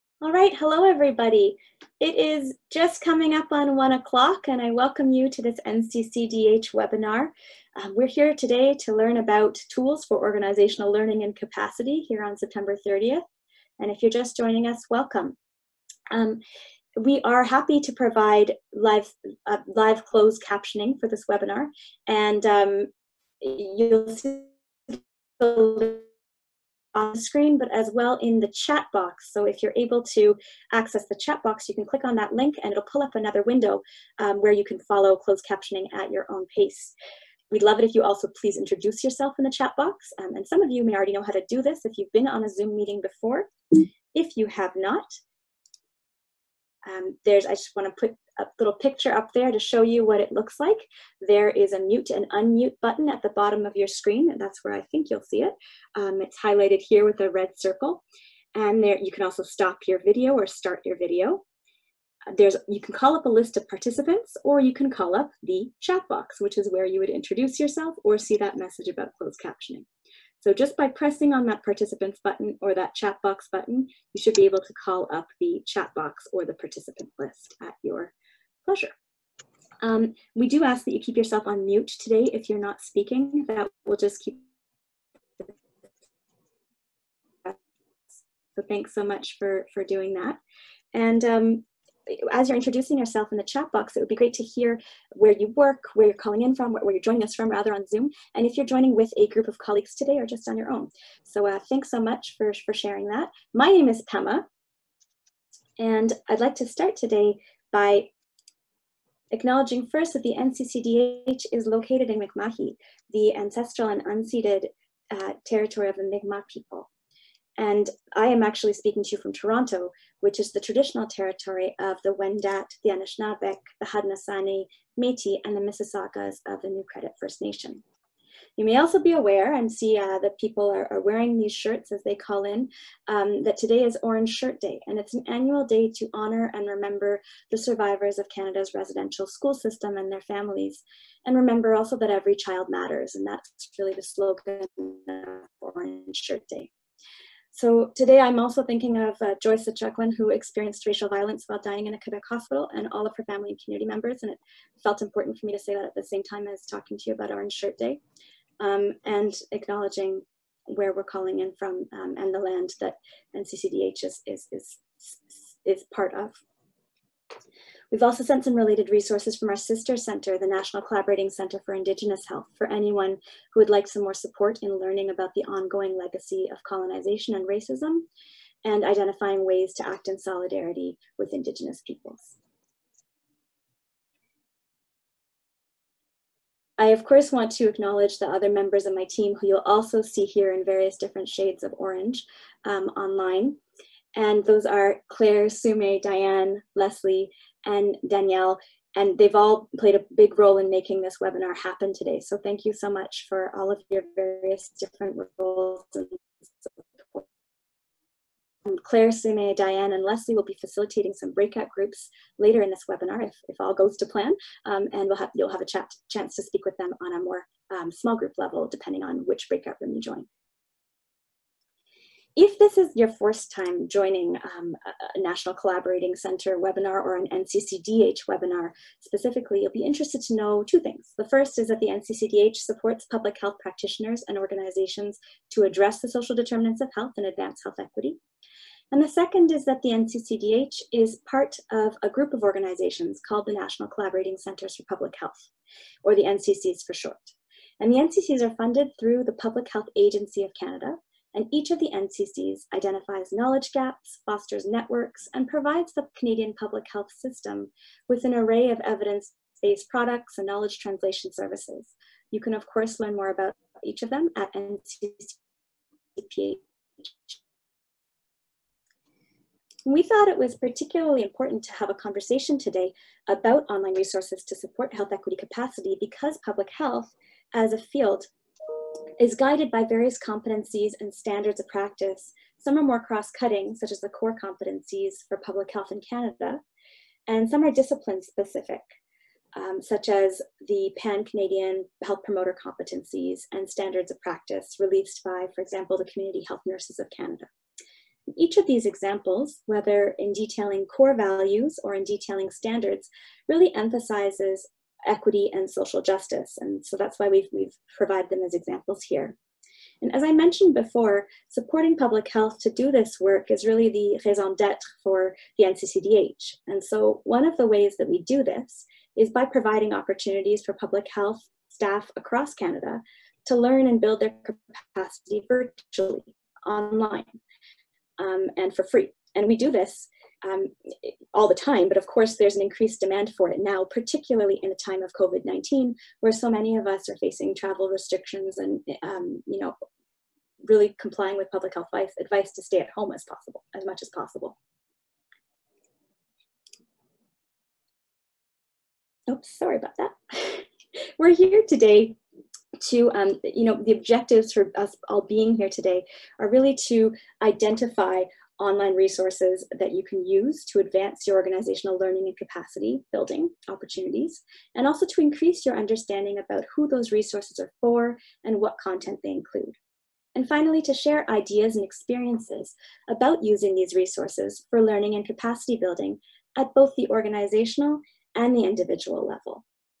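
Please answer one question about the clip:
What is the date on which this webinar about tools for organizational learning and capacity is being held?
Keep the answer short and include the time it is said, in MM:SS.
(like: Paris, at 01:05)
September 30th, at 00:12.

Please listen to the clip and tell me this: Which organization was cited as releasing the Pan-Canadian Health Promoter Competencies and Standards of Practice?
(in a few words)
Community Health Nurses of Canada.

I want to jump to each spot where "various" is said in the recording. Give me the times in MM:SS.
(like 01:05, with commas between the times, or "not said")
03:10, 03:24, 04:39.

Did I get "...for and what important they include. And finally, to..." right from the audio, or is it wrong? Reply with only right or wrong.
wrong.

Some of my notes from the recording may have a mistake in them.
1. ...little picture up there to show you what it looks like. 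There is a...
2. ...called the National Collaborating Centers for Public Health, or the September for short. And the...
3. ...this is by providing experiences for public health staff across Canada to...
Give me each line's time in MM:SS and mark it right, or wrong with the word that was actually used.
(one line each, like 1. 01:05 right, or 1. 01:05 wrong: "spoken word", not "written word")
1. 00:48 right
2. 04:03 wrong: "NCCs", not "September"
3. 05:18 wrong: "opportunities", not "experiences".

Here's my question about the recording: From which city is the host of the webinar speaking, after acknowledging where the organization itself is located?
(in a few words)
Toronto.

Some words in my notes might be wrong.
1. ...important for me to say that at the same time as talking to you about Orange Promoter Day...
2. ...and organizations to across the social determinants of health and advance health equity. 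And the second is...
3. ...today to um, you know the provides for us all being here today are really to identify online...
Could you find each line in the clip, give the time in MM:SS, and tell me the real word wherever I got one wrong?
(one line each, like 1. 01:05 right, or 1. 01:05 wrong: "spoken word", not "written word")
1. 02:35 wrong: "Shirt", not "Promoter"
2. 03:54 wrong: "address", not "across"
3. 05:51 wrong: "objectives", not "provides".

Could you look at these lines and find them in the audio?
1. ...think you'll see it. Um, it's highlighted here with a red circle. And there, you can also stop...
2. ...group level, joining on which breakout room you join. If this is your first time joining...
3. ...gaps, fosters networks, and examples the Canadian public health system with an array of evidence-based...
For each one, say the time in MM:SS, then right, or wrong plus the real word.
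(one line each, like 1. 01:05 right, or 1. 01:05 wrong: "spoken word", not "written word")
1. 00:54 right
2. 03:38 wrong: "depending", not "joining"
3. 04:13 wrong: "provides", not "examples".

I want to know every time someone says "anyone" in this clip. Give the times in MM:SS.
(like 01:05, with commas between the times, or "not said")
02:52.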